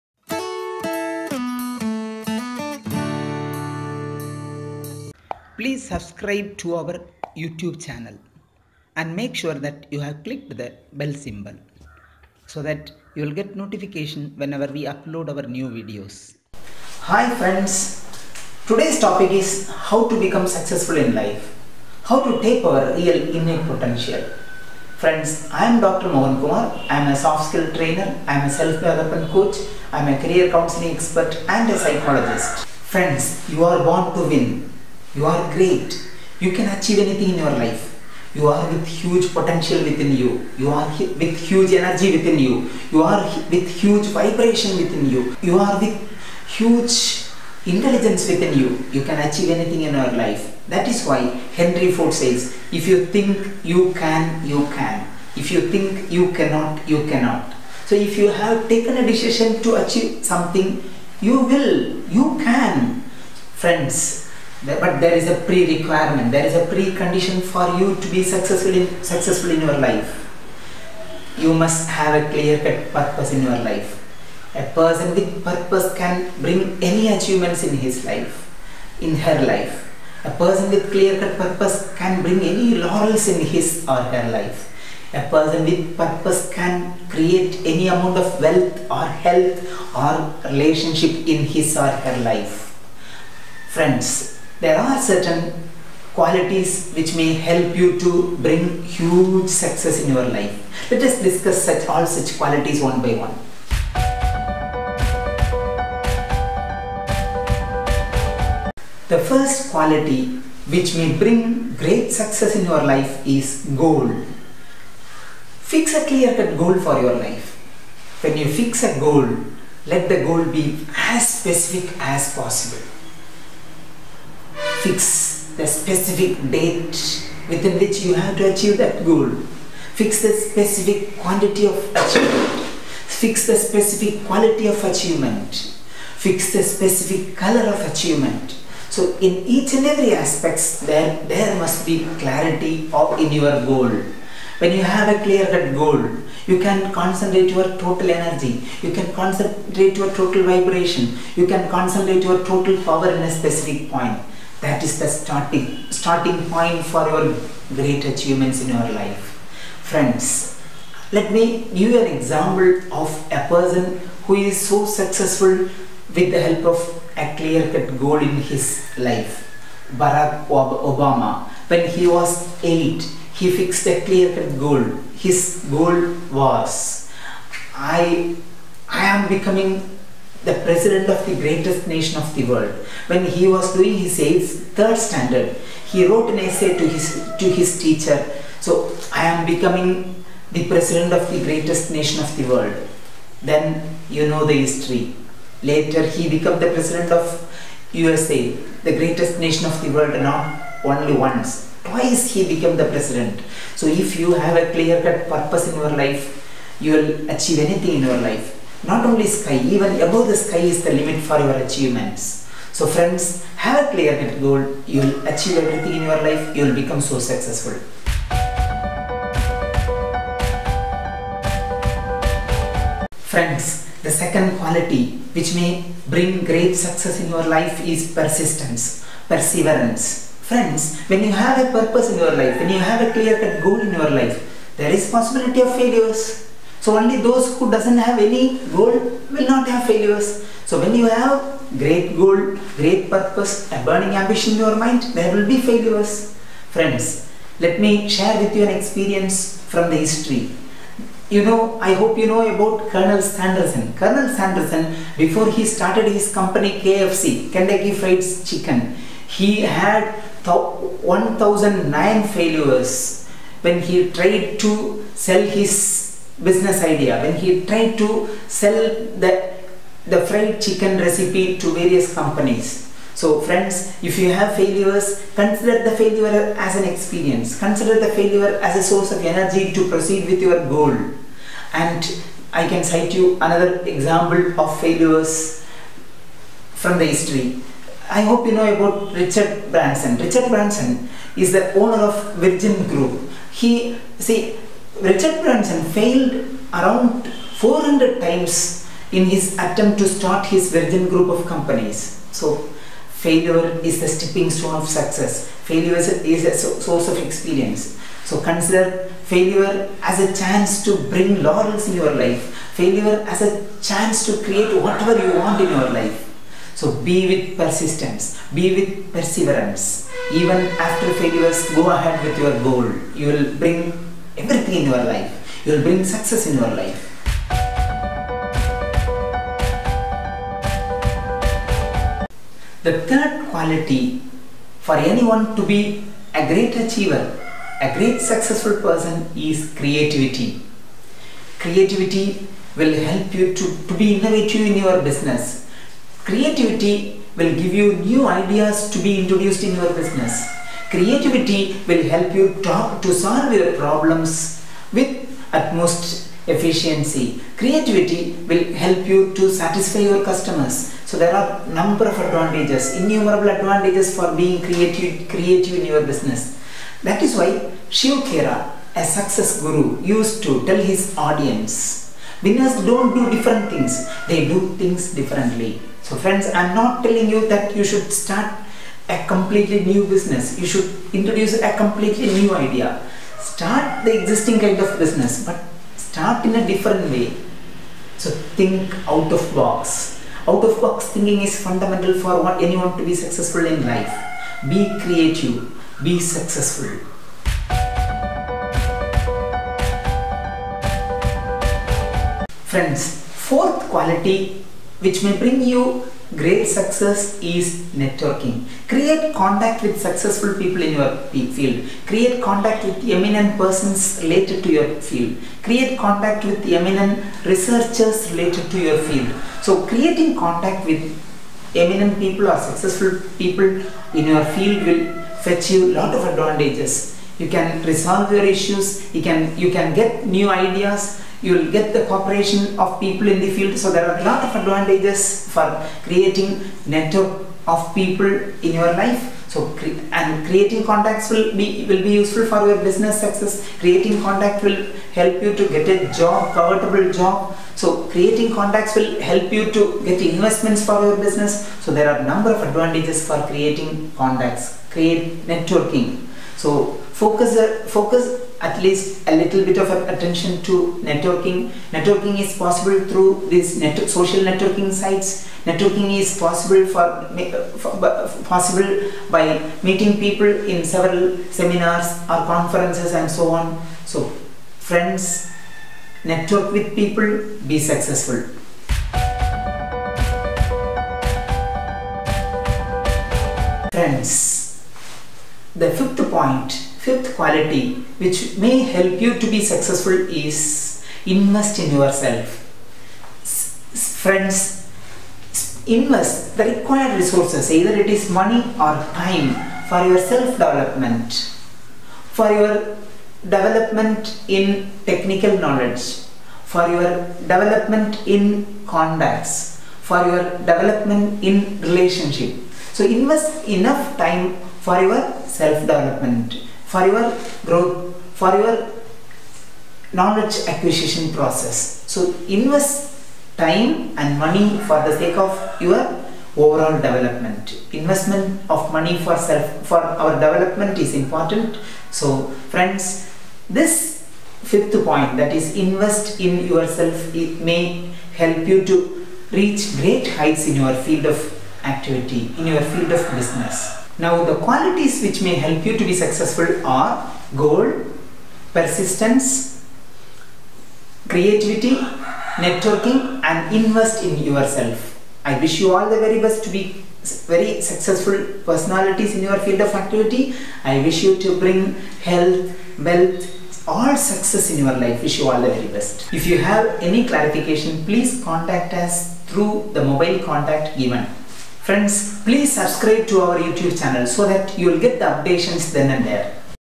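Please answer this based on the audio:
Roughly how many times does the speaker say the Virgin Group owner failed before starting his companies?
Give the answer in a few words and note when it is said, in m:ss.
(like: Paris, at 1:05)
400, at 4:57.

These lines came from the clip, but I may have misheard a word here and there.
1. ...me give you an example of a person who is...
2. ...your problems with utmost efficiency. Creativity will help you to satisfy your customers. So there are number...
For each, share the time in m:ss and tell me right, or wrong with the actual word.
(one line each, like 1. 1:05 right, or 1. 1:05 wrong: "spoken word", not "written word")
1. 2:41 right
2. 5:53 right.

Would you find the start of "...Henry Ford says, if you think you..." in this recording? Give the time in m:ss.
0:51.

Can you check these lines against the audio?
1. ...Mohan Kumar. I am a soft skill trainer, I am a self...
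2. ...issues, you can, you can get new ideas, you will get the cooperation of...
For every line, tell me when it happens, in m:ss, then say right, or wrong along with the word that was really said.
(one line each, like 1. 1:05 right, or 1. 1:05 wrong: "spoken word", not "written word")
1. 0:26 right
2. 7:08 right.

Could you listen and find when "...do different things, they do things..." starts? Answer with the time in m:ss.
6:13.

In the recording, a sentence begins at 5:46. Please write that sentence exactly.
Creativity will give you new ideas to be introduced in your business.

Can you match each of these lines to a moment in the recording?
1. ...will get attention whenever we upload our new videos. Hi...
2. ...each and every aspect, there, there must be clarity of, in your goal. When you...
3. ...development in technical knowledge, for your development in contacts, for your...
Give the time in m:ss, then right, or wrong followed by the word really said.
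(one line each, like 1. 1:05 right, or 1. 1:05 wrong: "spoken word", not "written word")
1. 0:13 wrong: "notification", not "attention"
2. 2:19 right
3. 8:23 right.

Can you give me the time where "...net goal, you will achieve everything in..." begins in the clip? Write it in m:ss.
3:34.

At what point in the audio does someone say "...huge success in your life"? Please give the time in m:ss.
1:38.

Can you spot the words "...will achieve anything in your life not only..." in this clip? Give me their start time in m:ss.
3:26.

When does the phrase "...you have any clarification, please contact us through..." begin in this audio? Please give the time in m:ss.
9:26.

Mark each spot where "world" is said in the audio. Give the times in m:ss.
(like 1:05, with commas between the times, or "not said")
3:02, 3:12, 3:19.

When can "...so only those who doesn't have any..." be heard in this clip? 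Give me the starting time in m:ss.
3:56.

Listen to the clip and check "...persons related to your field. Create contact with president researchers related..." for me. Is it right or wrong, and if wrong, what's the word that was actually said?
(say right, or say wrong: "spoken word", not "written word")
wrong: "eminent", not "president".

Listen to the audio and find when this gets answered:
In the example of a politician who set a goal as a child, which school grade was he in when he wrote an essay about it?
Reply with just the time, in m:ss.
3:04.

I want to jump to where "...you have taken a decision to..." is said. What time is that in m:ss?
0:58.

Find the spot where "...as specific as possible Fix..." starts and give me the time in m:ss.
2:00.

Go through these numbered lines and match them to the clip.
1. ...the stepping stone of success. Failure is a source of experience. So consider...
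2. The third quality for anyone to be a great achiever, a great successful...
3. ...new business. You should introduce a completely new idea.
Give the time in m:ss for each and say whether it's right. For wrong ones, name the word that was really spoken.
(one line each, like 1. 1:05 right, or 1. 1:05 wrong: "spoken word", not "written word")
1. 5:03 right
2. 5:32 right
3. 6:19 right.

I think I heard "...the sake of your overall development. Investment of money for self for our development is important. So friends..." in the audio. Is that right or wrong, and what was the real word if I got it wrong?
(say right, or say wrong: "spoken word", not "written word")
right.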